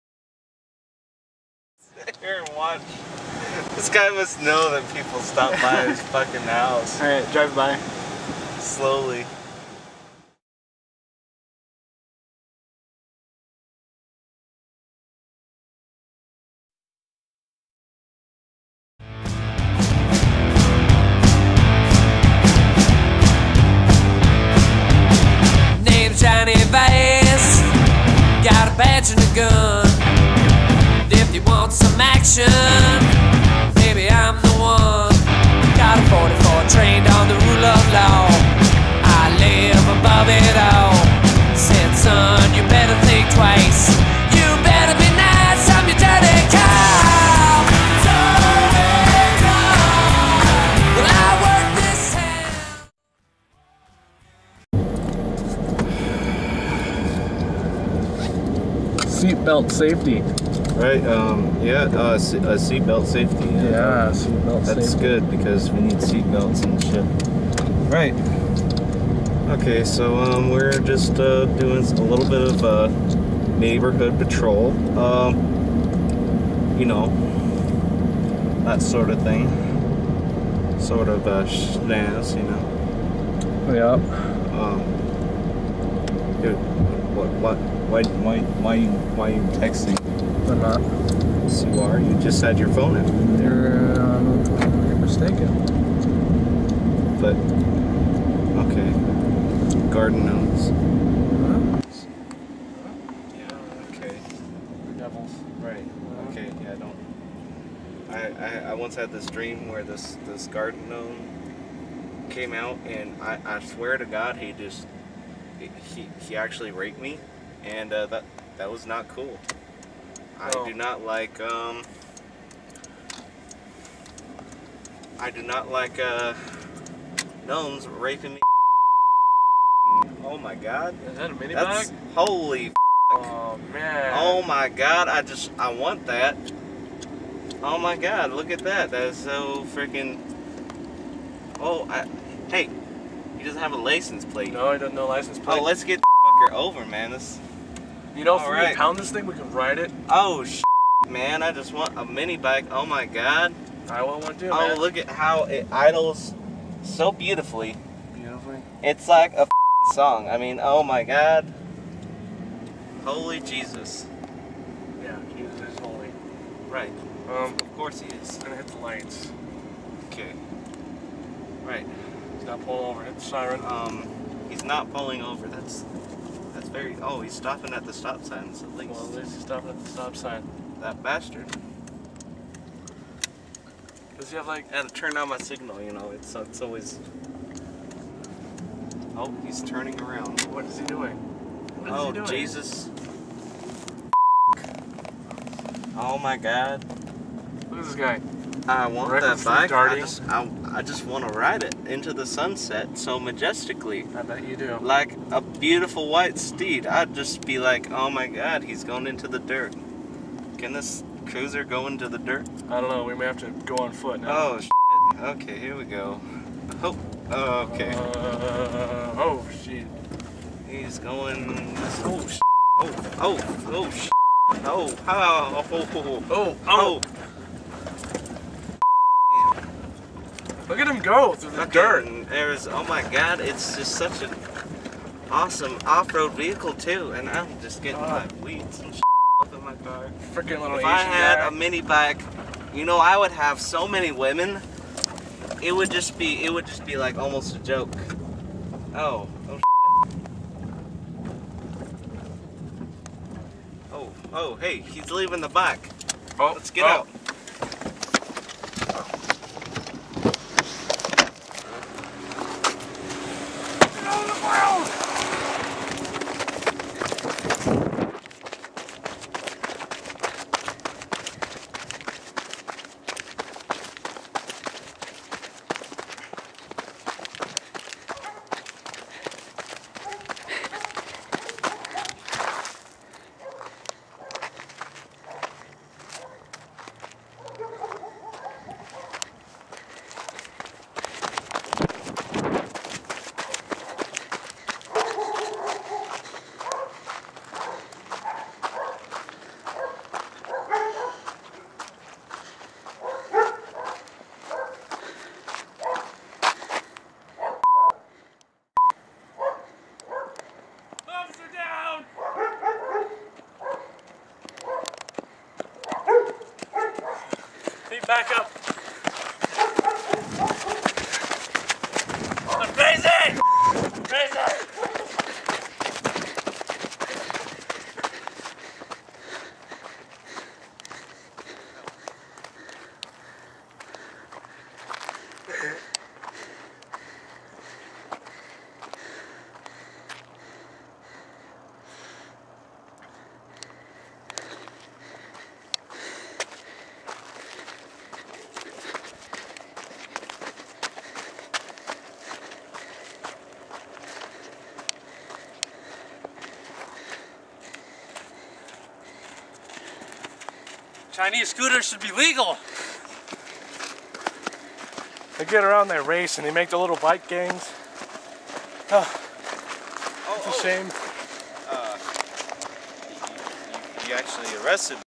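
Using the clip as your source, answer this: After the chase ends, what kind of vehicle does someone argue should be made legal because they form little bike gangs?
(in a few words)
Chinese scooters.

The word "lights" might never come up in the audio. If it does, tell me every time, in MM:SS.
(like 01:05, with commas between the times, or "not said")
02:48.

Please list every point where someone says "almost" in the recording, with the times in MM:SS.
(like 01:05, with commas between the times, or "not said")
04:07.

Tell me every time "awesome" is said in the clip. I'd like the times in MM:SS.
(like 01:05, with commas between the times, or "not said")
03:55.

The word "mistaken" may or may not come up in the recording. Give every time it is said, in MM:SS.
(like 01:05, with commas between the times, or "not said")
01:34.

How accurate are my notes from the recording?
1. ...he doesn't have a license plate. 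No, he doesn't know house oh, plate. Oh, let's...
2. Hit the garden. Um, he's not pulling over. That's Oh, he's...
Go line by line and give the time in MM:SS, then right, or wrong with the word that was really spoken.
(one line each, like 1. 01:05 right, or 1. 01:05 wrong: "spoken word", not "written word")
1. 02:23 wrong: "license", not "house"
2. 02:53 wrong: "siren", not "garden".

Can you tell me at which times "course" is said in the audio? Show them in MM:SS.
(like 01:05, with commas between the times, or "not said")
02:47.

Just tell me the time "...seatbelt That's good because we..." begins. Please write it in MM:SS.
01:04.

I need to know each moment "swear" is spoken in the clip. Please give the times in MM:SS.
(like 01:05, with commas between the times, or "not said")
01:53.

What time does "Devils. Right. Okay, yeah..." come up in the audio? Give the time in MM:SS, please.
01:44.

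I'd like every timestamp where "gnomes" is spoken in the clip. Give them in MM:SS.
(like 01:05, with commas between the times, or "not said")
01:40, 01:50, 02:07.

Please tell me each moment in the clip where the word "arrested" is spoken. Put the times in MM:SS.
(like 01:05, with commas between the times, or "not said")
06:14.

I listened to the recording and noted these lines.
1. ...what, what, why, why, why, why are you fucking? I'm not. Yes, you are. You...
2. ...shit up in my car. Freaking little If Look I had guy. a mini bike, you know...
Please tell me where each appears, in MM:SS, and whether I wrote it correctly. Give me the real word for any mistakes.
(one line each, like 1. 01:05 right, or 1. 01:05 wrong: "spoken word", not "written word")
1. 01:27 wrong: "texting", not "fucking"
2. 03:58 wrong: "Asian", not "Look".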